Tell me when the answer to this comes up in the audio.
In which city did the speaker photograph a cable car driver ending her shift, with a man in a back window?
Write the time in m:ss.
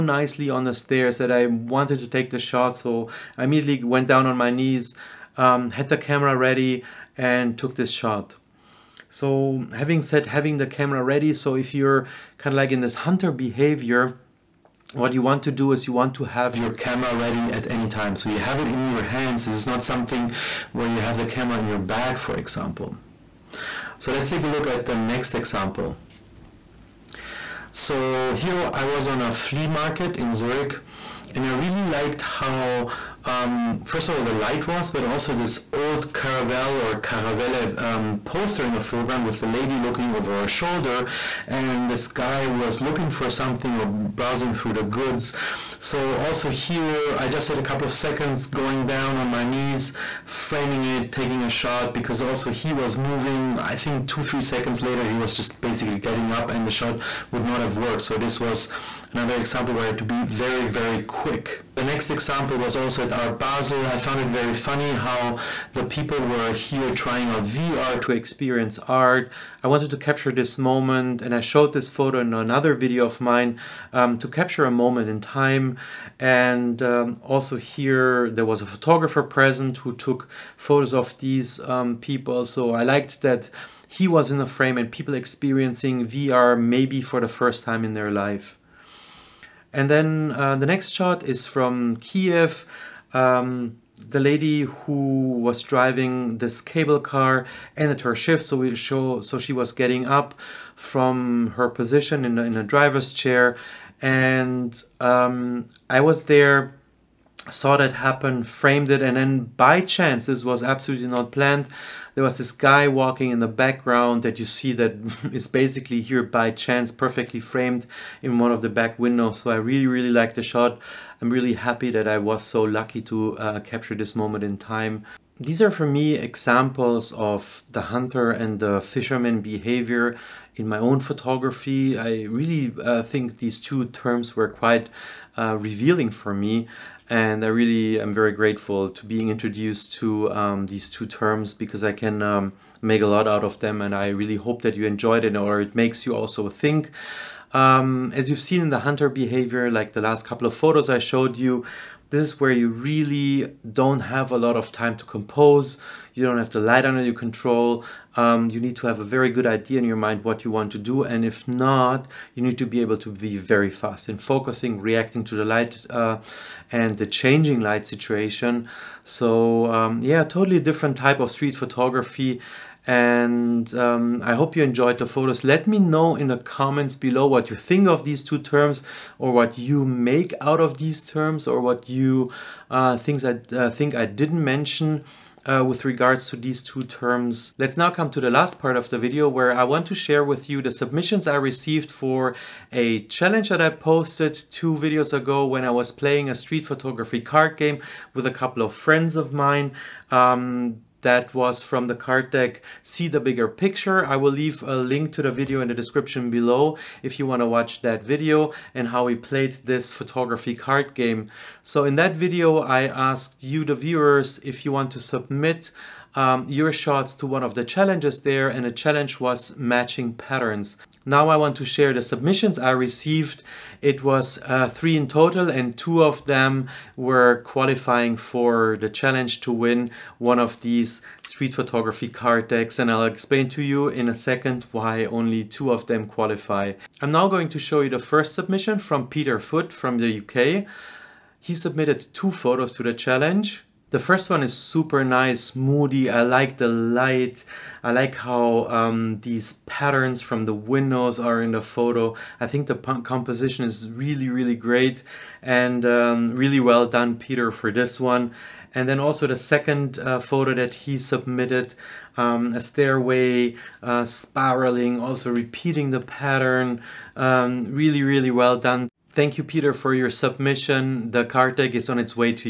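1:31.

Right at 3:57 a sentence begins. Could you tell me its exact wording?
I'm now going to show you the first submission from Peter Foot from the UK.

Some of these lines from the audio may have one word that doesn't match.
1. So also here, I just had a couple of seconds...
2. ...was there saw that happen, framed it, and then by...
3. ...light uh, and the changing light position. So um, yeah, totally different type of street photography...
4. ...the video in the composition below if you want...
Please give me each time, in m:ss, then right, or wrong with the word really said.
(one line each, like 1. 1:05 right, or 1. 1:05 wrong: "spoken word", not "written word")
1. 0:45 right
2. 1:46 right
3. 2:45 wrong: "situation", not "position"
4. 3:25 wrong: "description", not "composition".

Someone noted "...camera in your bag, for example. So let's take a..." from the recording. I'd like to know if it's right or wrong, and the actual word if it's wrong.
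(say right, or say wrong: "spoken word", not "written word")
right.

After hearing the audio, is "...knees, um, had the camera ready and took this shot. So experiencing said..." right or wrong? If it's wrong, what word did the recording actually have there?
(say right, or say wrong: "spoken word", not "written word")
wrong: "having", not "experiencing".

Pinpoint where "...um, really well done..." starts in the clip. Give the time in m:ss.
4:15.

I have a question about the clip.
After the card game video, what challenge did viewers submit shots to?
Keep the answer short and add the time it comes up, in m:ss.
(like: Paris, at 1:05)
matching patterns, at 3:39.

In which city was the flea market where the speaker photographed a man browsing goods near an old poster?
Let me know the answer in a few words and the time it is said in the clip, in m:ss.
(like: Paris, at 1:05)
Zurich, at 0:30.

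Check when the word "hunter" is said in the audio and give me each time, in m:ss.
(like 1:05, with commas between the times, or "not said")
0:12, 2:07, 2:28.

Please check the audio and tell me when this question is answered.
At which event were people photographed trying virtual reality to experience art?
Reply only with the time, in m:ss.
1:03.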